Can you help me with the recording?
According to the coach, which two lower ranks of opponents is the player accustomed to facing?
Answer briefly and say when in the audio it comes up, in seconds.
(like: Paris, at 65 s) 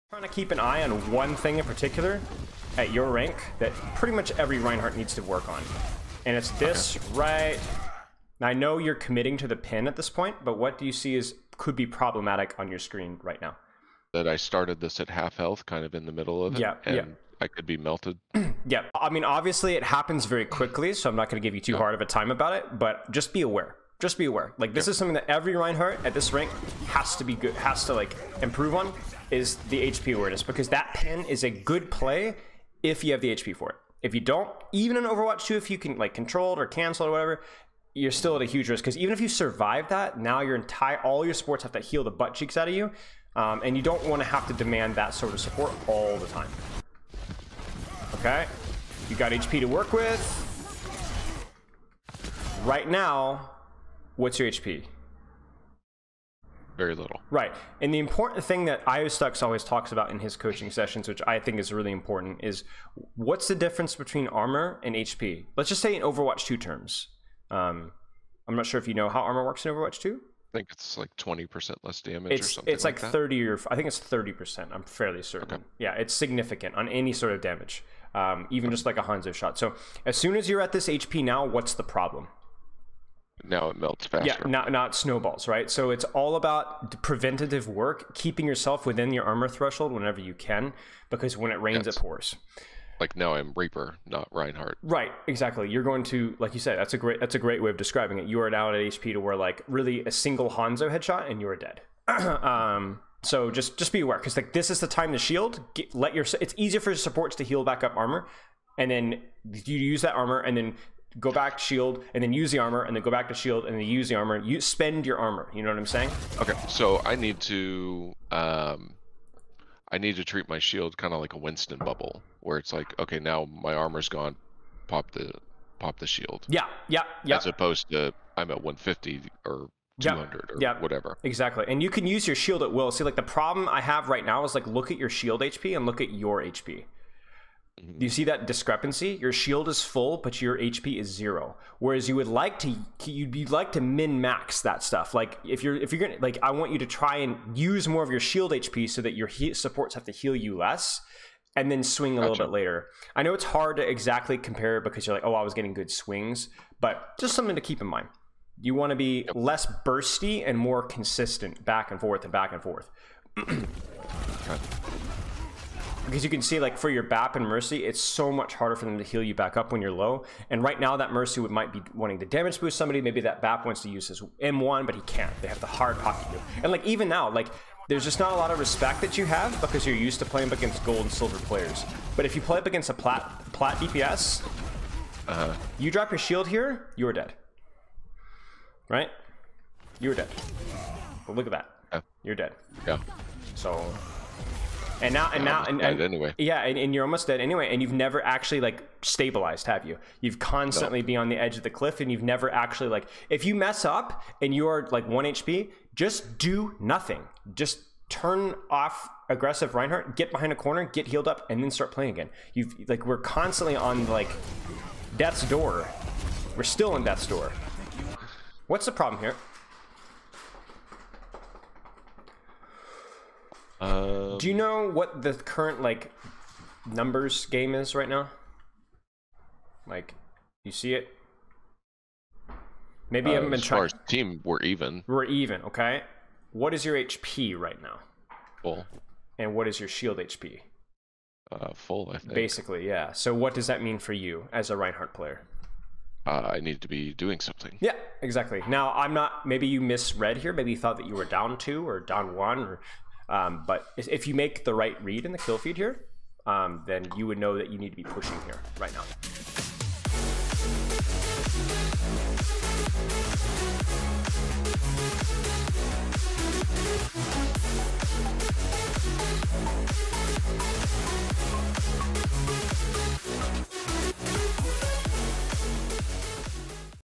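gold and silver, at 180 s.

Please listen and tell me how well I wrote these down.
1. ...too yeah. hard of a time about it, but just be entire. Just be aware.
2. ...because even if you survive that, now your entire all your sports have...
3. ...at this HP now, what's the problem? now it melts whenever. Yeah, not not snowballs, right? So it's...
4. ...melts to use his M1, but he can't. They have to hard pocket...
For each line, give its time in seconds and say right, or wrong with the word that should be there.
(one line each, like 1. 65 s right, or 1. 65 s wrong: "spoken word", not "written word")
1. 21 s wrong: "aware", not "entire"
2. 38 s right
3. 80 s wrong: "faster", not "whenever"
4. 173 s wrong: "wants", not "melts".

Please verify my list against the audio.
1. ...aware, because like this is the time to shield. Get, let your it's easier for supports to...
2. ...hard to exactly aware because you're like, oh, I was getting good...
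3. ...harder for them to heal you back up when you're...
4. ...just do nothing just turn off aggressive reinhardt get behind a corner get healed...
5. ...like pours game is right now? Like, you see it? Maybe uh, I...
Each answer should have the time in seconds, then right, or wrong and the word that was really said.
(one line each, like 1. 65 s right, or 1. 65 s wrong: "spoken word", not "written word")
1. 104 s right
2. 153 s wrong: "compare", not "aware"
3. 168 s right
4. 205 s right
5. 225 s wrong: "numbers", not "pours".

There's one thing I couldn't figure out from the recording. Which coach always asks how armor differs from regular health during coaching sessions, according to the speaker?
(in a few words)
Iostux.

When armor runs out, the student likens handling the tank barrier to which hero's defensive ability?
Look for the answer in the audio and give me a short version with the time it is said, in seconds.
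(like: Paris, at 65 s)
Winston, at 121 s.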